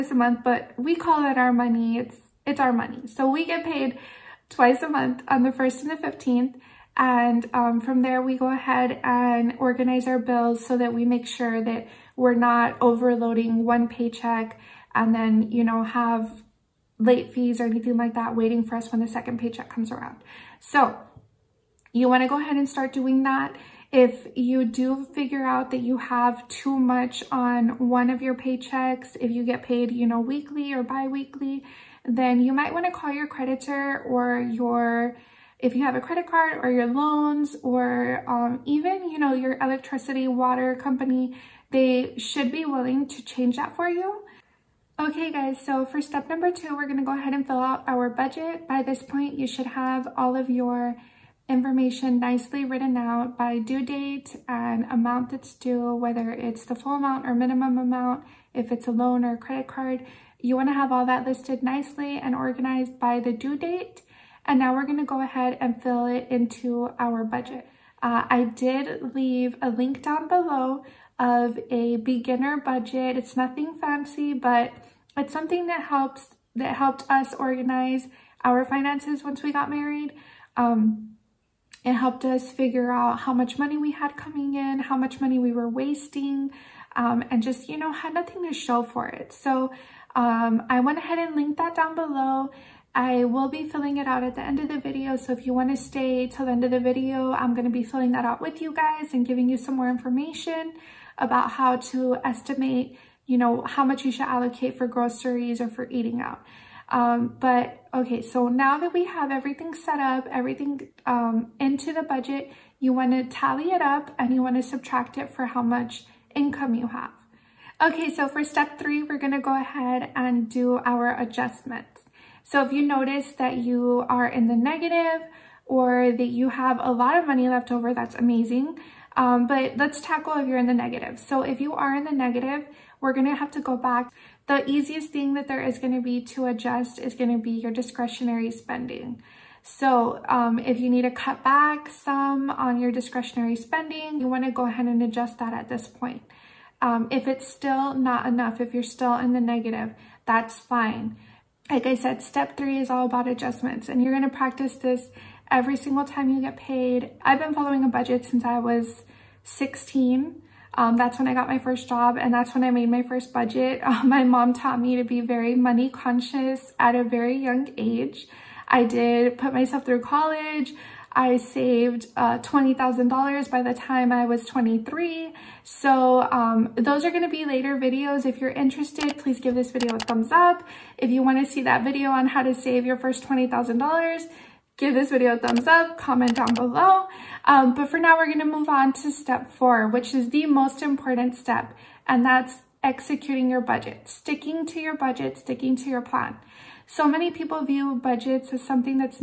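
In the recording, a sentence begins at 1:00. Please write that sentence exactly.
You wanna have all that listed nicely and organized by the due date.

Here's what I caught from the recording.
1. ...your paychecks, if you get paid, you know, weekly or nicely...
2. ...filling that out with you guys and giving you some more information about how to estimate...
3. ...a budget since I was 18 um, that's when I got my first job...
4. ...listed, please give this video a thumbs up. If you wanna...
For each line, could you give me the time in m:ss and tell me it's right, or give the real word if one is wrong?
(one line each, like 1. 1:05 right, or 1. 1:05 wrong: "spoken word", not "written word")
1. 0:28 wrong: "biweekly", not "nicely"
2. 1:37 right
3. 2:37 wrong: "16", not "18"
4. 2:58 wrong: "interested", not "listed".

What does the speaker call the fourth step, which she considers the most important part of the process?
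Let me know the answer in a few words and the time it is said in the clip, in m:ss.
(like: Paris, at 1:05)
Executing your budget, at 3:12.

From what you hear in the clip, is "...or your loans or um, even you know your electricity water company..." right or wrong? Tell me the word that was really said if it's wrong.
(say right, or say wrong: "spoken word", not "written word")
right.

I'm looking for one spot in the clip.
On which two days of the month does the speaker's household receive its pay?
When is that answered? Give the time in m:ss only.
0:05.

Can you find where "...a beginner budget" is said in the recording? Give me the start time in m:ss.
1:11.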